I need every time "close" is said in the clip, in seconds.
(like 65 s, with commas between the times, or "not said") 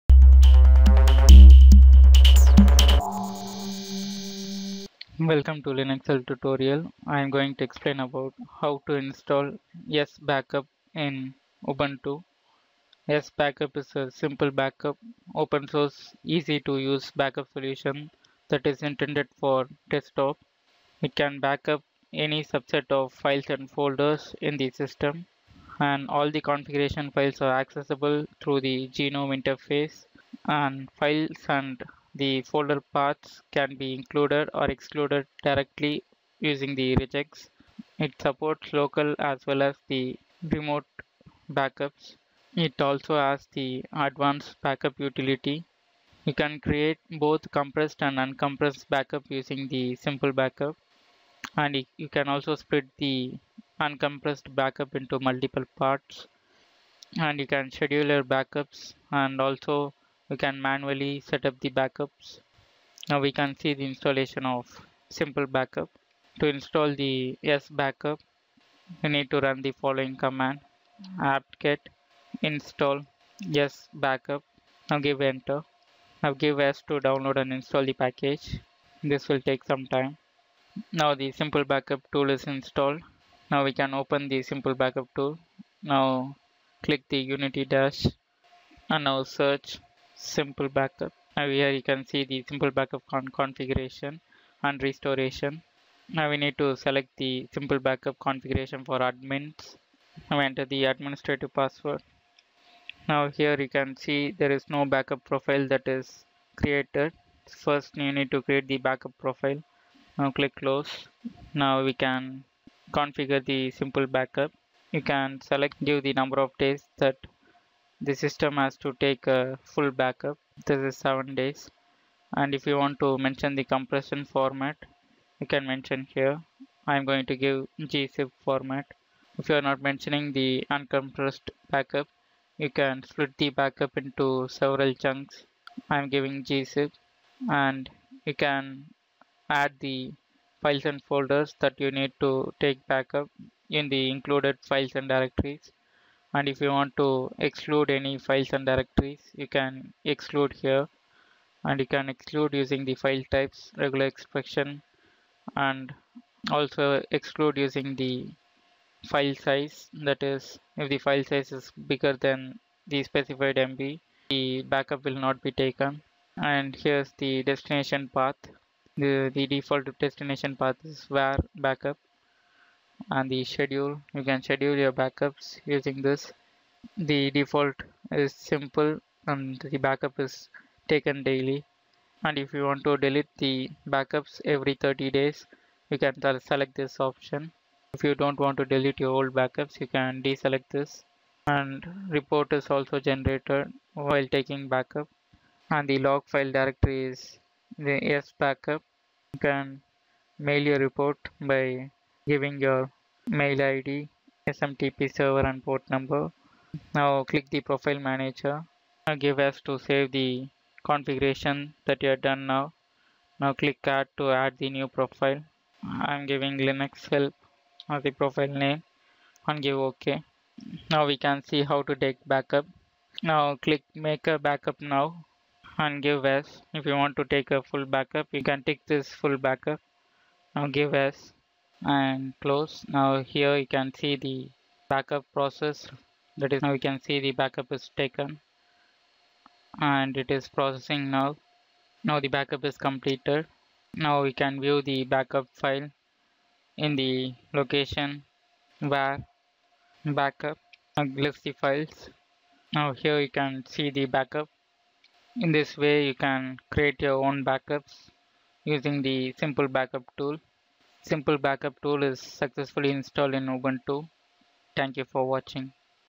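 110 s, 232 s.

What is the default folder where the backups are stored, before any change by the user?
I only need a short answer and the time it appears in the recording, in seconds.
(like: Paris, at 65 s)
var backup, at 171 s.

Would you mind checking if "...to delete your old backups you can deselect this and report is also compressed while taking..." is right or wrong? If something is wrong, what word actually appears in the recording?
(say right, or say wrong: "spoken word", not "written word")
wrong: "generated", not "compressed".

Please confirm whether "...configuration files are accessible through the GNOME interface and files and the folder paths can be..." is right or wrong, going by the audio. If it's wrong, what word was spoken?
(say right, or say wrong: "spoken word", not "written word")
right.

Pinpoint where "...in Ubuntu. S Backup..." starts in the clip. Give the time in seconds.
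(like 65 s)
10 s.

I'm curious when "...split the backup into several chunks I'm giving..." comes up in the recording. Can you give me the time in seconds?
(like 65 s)
133 s.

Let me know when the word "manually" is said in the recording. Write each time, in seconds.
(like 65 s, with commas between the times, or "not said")
60 s.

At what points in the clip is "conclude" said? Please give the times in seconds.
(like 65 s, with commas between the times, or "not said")
not said.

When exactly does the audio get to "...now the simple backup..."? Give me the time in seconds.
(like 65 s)
81 s.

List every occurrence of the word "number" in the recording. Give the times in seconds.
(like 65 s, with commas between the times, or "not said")
116 s, 205 s.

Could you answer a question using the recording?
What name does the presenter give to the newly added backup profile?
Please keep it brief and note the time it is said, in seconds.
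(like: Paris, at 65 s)
linux help, at 216 s.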